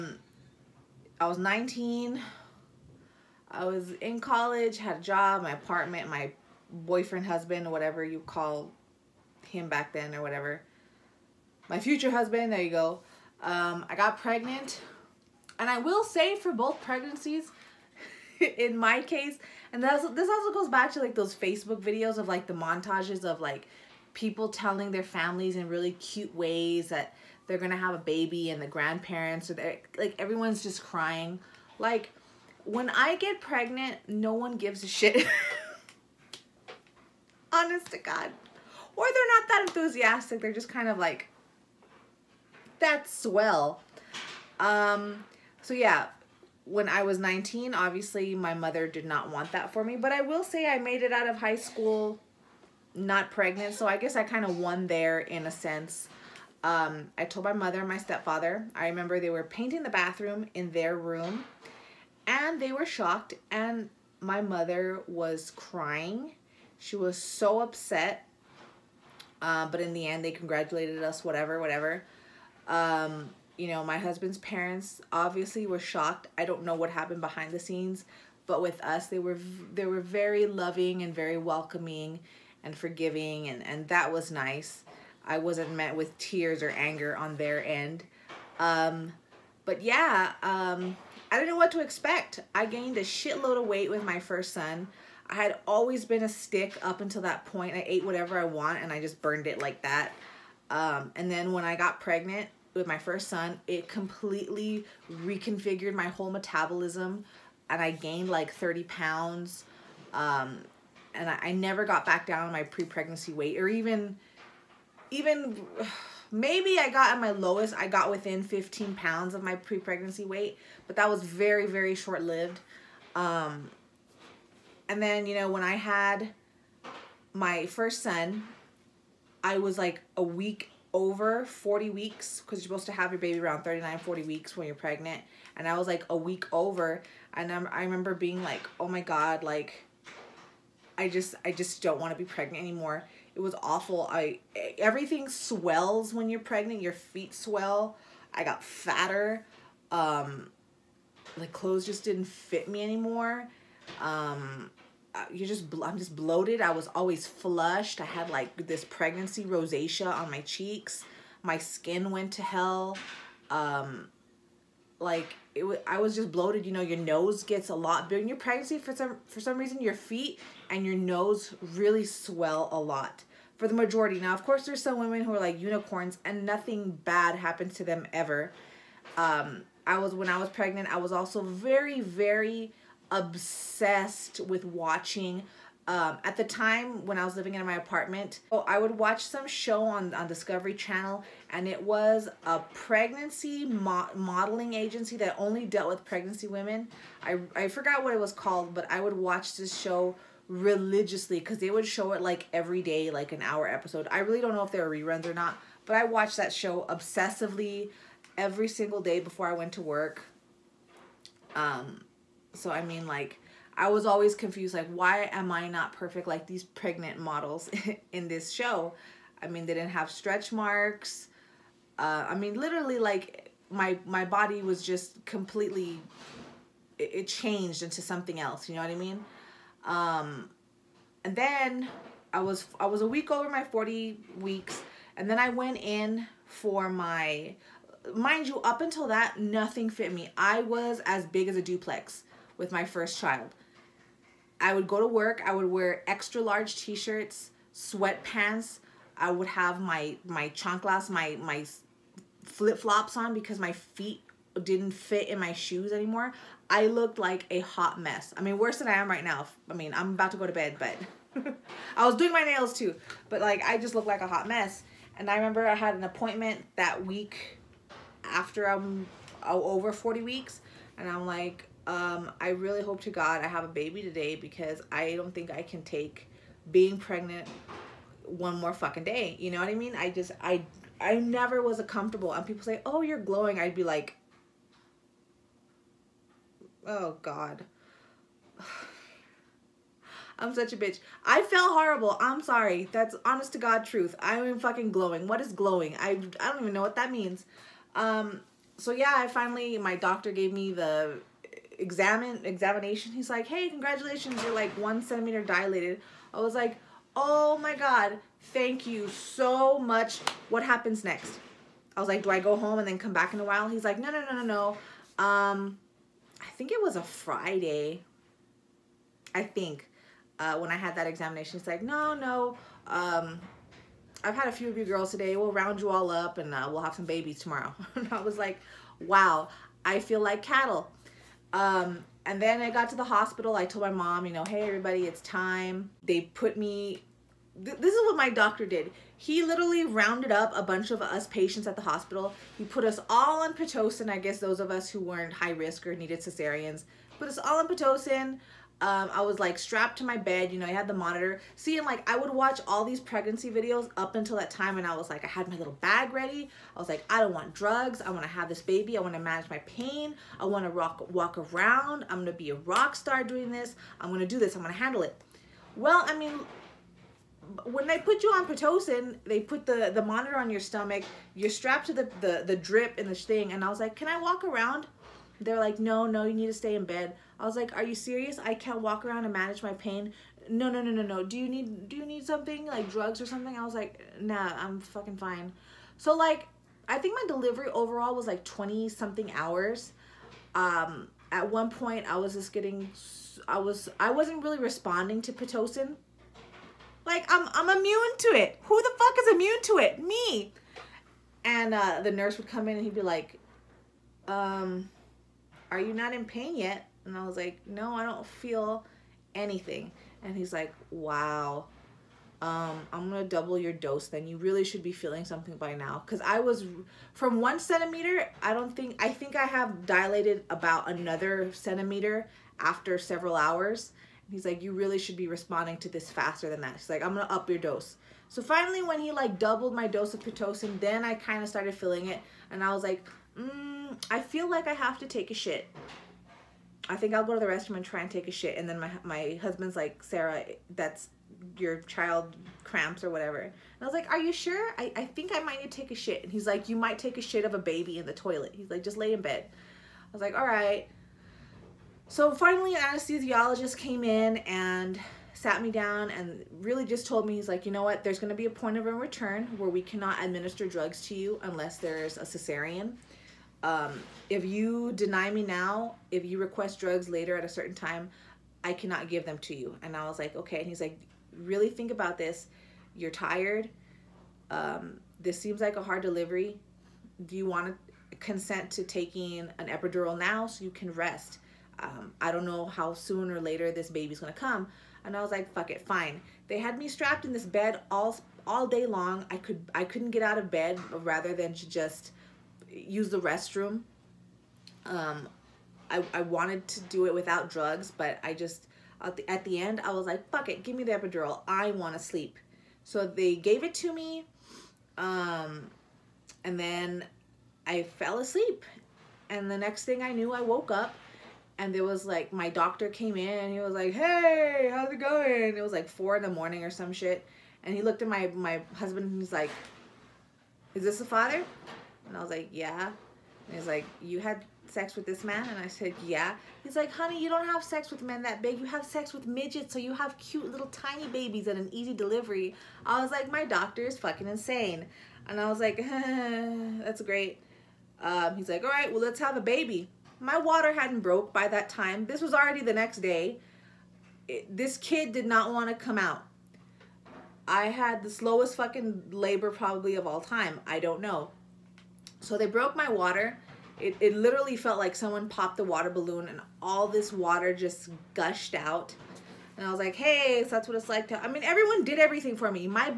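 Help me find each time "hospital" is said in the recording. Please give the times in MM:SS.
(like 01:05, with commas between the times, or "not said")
05:33, 05:41.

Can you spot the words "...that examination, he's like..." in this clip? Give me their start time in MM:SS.
05:20.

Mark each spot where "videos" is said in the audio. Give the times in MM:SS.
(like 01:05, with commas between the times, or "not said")
00:21, 05:53.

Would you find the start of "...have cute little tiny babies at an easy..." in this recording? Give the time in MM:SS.
08:49.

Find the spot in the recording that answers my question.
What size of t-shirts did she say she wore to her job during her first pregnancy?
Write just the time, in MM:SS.
04:06.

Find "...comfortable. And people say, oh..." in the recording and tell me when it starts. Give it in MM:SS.
04:41.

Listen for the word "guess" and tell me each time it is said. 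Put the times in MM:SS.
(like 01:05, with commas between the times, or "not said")
00:53, 05:44.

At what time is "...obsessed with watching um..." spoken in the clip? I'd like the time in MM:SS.
03:03.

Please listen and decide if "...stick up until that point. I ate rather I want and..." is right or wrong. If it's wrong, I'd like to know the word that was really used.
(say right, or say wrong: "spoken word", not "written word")
wrong: "whatever", not "rather".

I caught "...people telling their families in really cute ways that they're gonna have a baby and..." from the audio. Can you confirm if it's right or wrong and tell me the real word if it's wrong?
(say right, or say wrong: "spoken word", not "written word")
right.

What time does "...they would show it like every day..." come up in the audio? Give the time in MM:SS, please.
03:21.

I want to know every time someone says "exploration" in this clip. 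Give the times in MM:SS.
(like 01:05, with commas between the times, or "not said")
not said.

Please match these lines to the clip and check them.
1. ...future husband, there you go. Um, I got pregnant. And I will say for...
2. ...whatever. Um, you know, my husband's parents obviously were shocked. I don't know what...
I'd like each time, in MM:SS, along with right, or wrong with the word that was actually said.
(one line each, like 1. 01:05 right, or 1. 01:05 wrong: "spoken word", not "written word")
1. 00:11 right
2. 01:11 right.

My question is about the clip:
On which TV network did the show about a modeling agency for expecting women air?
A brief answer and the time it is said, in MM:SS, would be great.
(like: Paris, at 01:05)
Discovery Channel, at 03:10.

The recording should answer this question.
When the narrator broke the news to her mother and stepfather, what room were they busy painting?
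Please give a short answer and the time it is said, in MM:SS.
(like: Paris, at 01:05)
bathroom, at 00:59.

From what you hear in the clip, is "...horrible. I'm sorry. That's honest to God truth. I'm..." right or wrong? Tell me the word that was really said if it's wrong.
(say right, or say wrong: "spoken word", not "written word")
right.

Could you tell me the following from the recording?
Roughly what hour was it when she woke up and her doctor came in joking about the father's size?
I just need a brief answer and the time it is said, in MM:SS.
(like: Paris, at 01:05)
4 in the morning, at 08:35.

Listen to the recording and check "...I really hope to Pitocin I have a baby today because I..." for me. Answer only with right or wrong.
wrong.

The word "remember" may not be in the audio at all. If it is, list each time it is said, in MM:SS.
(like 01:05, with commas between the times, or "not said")
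00:58, 02:17, 04:25.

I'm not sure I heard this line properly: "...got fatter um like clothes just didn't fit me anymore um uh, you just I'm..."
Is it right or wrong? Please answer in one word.
right.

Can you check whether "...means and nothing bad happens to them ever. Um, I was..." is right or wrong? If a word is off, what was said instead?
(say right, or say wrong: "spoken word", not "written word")
wrong: "unicorns", not "means".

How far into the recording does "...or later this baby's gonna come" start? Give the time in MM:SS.
08:03.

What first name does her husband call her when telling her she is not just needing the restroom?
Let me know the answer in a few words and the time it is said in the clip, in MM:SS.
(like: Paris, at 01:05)
Sarah, at 07:20.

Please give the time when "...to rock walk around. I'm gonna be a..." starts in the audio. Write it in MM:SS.
06:00.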